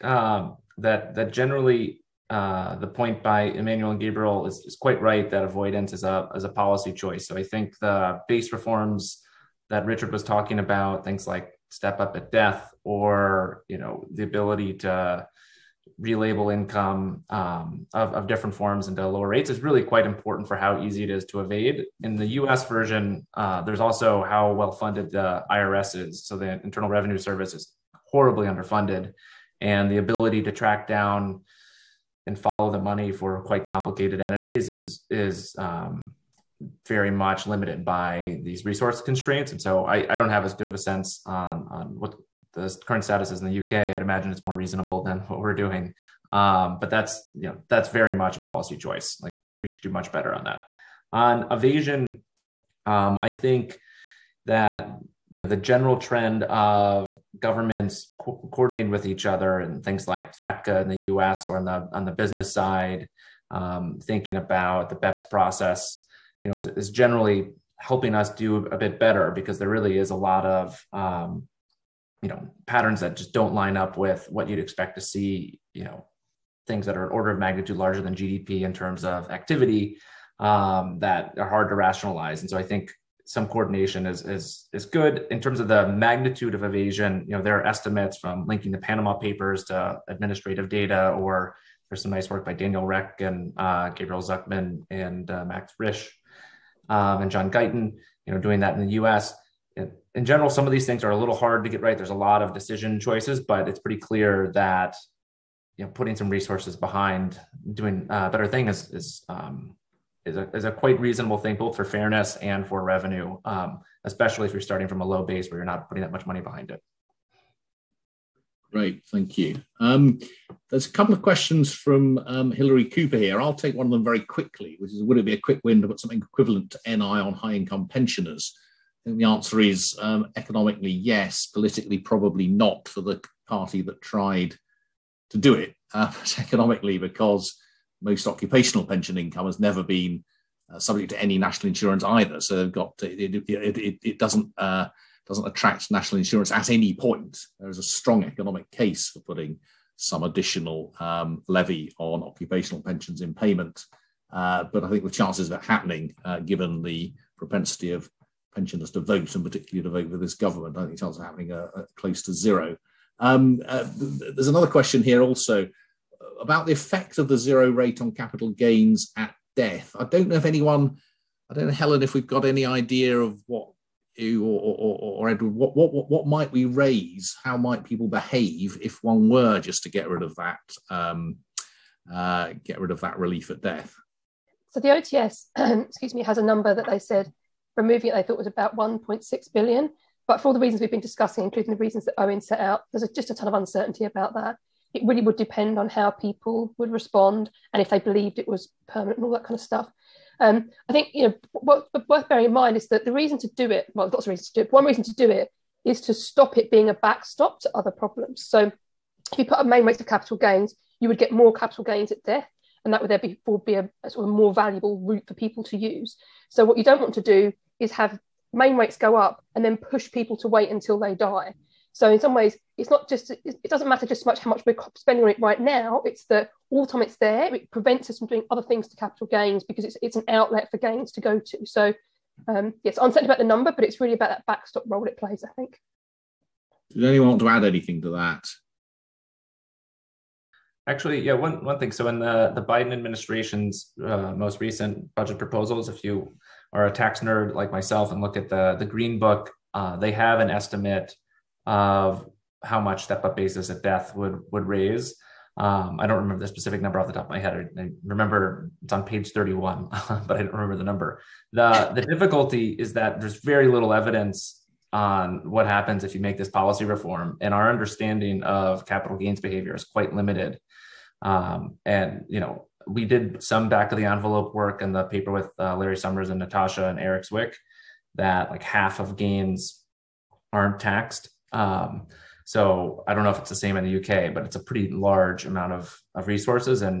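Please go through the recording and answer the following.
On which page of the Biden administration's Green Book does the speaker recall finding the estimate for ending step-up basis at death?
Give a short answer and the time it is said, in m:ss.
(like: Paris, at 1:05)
31, at 4:19.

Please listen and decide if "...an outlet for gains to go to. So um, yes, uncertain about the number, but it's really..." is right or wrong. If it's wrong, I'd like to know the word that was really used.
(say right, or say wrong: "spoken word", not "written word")
right.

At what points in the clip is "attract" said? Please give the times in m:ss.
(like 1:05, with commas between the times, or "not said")
2:25.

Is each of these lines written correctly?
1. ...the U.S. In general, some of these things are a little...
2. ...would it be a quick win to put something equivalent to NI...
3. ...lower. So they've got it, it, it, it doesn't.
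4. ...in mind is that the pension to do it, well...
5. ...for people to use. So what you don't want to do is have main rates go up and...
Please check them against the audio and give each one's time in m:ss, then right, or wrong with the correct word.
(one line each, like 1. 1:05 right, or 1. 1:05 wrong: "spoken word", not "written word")
1. 1:38 right
2. 2:05 right
3. 2:22 wrong: "either", not "lower"
4. 3:22 wrong: "reason", not "pension"
5. 3:35 right.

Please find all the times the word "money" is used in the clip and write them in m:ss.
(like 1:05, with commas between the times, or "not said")
0:32, 1:56.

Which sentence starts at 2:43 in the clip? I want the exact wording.
Um, uh, there's another question here also uh, about the effect of the zero rate on capital gains at death.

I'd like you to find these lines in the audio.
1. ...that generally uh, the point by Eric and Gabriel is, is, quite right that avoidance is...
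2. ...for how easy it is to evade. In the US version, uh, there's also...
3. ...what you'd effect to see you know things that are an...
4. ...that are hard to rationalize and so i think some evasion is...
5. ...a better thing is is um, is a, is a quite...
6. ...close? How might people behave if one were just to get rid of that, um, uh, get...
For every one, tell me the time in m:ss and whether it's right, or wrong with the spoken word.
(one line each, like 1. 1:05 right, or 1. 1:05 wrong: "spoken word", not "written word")
1. 0:01 wrong: "Emmanuel", not "Eric"
2. 0:20 right
3. 1:14 wrong: "expect", not "effect"
4. 1:21 wrong: "coordination", not "evasion"
5. 1:48 right
6. 2:56 wrong: "raise", not "close".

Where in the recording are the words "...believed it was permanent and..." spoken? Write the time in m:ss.
3:17.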